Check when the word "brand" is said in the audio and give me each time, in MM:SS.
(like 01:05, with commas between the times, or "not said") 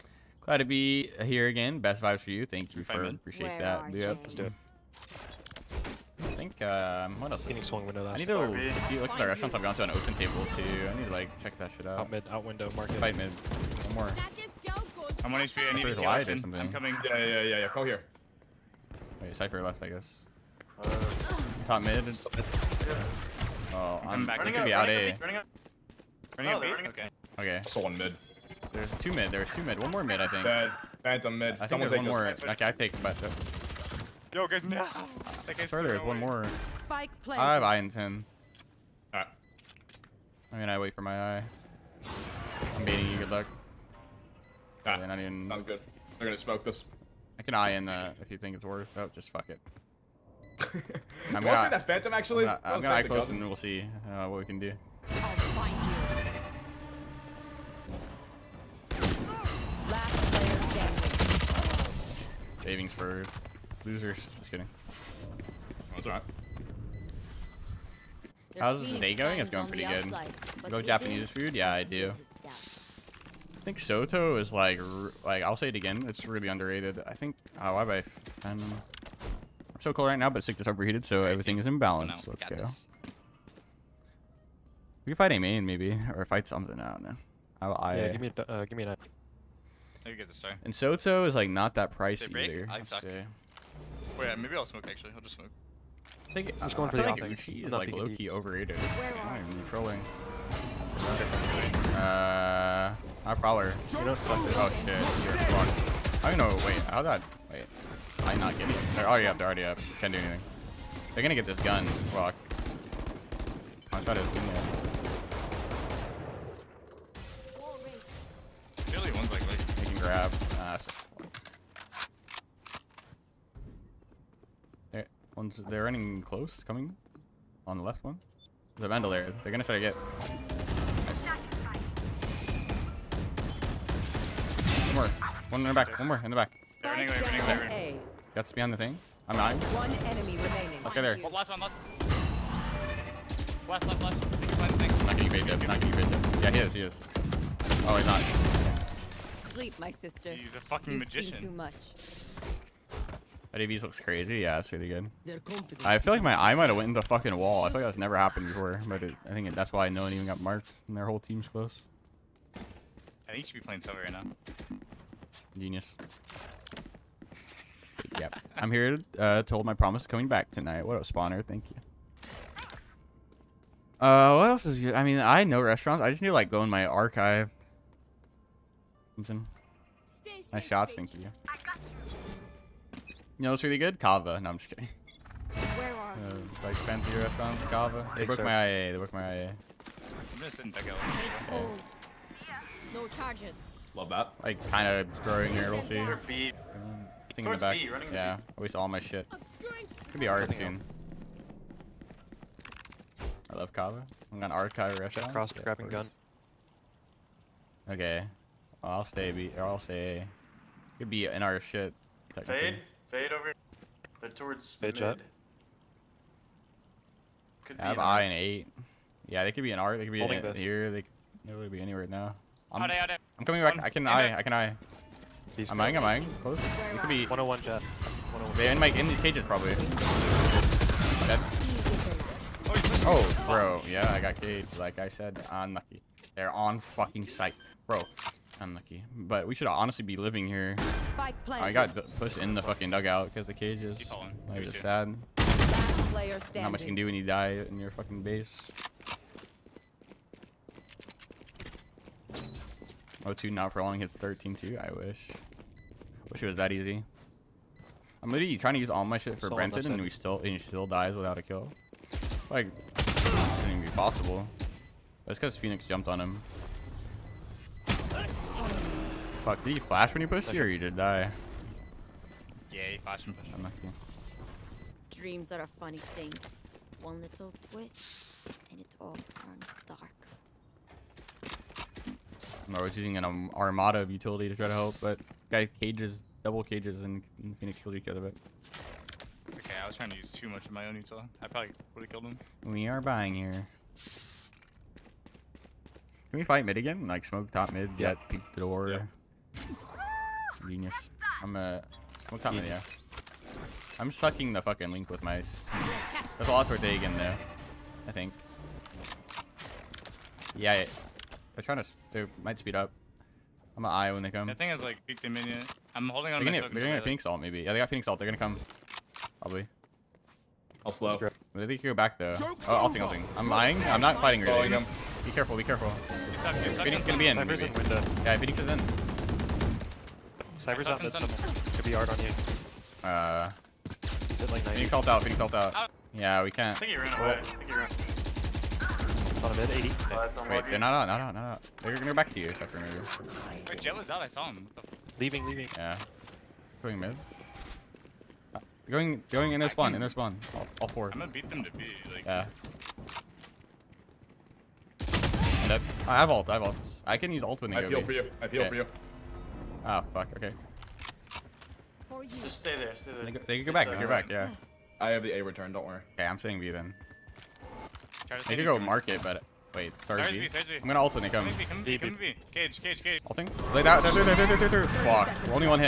not said.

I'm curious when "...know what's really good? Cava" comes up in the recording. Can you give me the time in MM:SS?
03:03.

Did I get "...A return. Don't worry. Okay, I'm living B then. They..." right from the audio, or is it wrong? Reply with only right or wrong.
wrong.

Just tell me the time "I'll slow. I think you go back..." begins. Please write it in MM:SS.
05:20.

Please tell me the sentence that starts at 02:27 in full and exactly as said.
Oh, he's not sleep, my sister.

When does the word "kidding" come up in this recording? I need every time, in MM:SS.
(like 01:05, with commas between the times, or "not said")
01:04, 03:04, 04:33.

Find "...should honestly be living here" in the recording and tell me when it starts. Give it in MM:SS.
03:59.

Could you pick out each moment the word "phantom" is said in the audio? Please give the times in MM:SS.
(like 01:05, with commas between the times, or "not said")
00:31, 00:51.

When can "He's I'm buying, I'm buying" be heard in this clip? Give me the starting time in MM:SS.
03:45.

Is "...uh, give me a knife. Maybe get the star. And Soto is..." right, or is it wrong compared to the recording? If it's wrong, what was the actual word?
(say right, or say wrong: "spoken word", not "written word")
right.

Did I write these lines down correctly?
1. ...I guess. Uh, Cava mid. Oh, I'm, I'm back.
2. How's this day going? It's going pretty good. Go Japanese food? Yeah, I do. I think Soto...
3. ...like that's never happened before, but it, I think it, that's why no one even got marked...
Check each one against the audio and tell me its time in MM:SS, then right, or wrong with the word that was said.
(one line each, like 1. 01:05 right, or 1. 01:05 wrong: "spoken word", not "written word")
1. 00:19 wrong: "Top", not "Cava"
2. 01:08 right
3. 02:37 right.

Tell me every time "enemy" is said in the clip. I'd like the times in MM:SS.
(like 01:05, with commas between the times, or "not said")
02:19.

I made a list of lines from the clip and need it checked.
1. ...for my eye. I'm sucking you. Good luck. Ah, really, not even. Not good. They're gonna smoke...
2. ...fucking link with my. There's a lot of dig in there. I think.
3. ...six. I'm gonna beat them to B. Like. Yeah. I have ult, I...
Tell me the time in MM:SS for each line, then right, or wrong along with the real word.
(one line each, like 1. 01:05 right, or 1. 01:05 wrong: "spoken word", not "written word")
1. 00:40 wrong: "baiting", not "sucking"
2. 05:04 right
3. 05:50 wrong: "four", not "six".